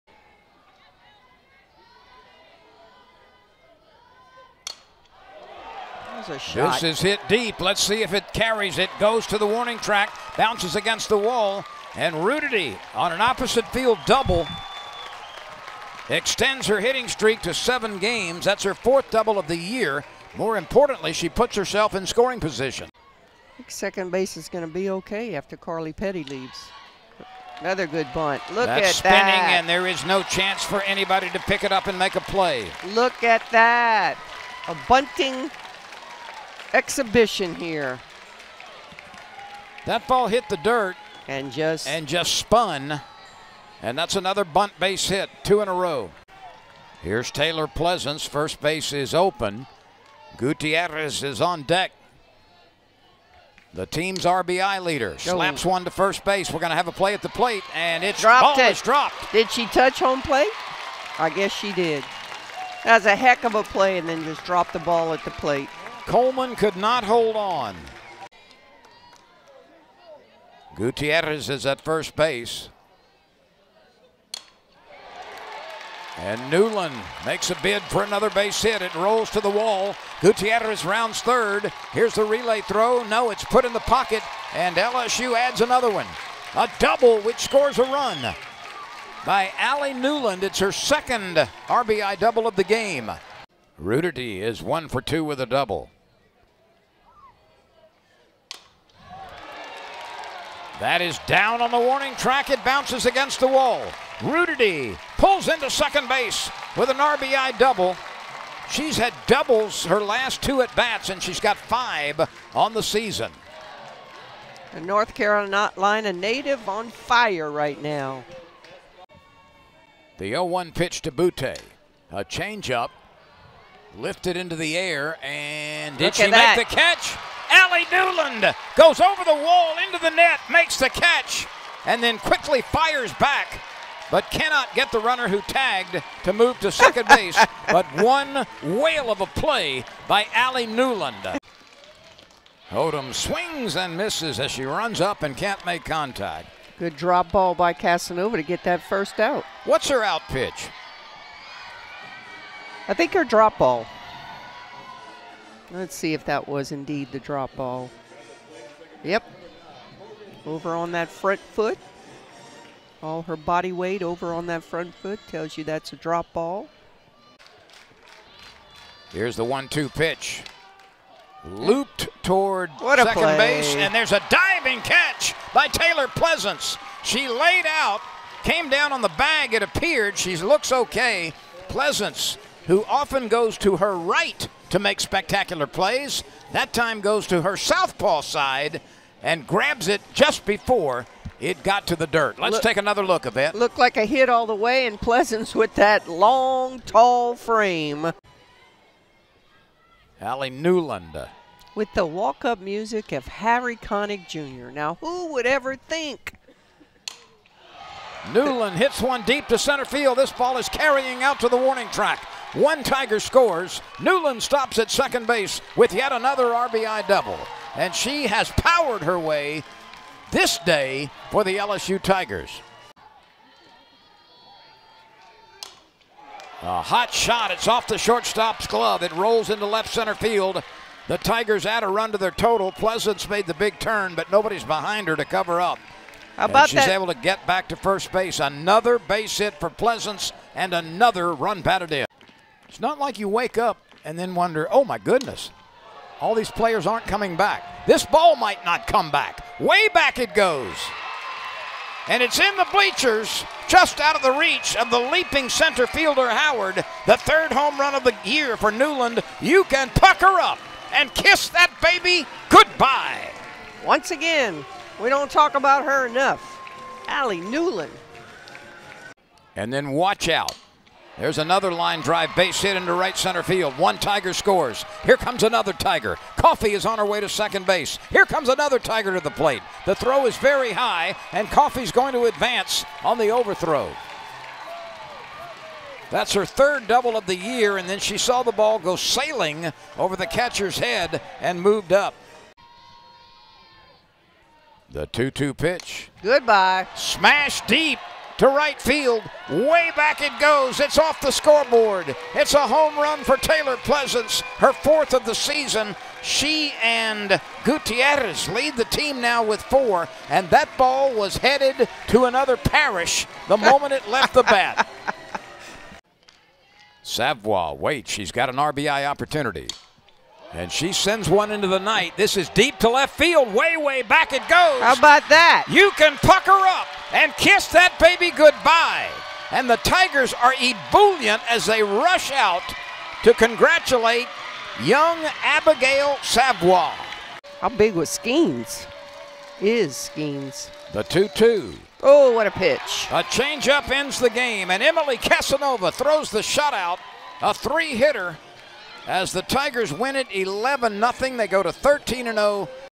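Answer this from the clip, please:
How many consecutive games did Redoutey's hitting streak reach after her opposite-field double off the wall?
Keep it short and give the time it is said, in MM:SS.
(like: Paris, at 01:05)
7, at 00:17.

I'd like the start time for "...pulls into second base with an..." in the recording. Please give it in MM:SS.
01:45.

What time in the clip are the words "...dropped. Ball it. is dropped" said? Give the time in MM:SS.
00:58.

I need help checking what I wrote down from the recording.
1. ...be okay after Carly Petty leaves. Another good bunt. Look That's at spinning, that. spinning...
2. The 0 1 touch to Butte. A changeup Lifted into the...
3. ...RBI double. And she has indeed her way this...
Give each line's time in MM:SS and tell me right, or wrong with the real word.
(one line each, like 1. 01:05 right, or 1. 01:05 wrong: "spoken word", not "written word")
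1. 00:24 right
2. 02:00 wrong: "pitch", not "touch"
3. 03:36 wrong: "powered", not "indeed".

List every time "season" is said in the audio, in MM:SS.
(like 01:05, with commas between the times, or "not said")
01:52, 05:05.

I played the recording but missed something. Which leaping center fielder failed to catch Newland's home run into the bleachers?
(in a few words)
Howard.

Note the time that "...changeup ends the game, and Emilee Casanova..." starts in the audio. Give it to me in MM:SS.
05:43.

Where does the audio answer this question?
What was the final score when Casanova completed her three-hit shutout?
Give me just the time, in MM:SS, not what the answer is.
05:50.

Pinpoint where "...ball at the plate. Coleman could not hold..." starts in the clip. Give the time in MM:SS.
01:04.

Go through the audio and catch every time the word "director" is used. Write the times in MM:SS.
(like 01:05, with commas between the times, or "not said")
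not said.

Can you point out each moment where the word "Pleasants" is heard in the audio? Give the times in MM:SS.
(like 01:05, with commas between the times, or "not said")
00:47, 02:56, 03:01, 03:15, 03:52, 03:59, 05:03.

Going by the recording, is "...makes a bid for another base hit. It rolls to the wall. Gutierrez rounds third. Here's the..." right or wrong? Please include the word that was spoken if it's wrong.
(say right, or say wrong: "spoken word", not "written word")
right.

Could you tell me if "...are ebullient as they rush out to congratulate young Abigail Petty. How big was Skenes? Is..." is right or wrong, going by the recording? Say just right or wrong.
wrong.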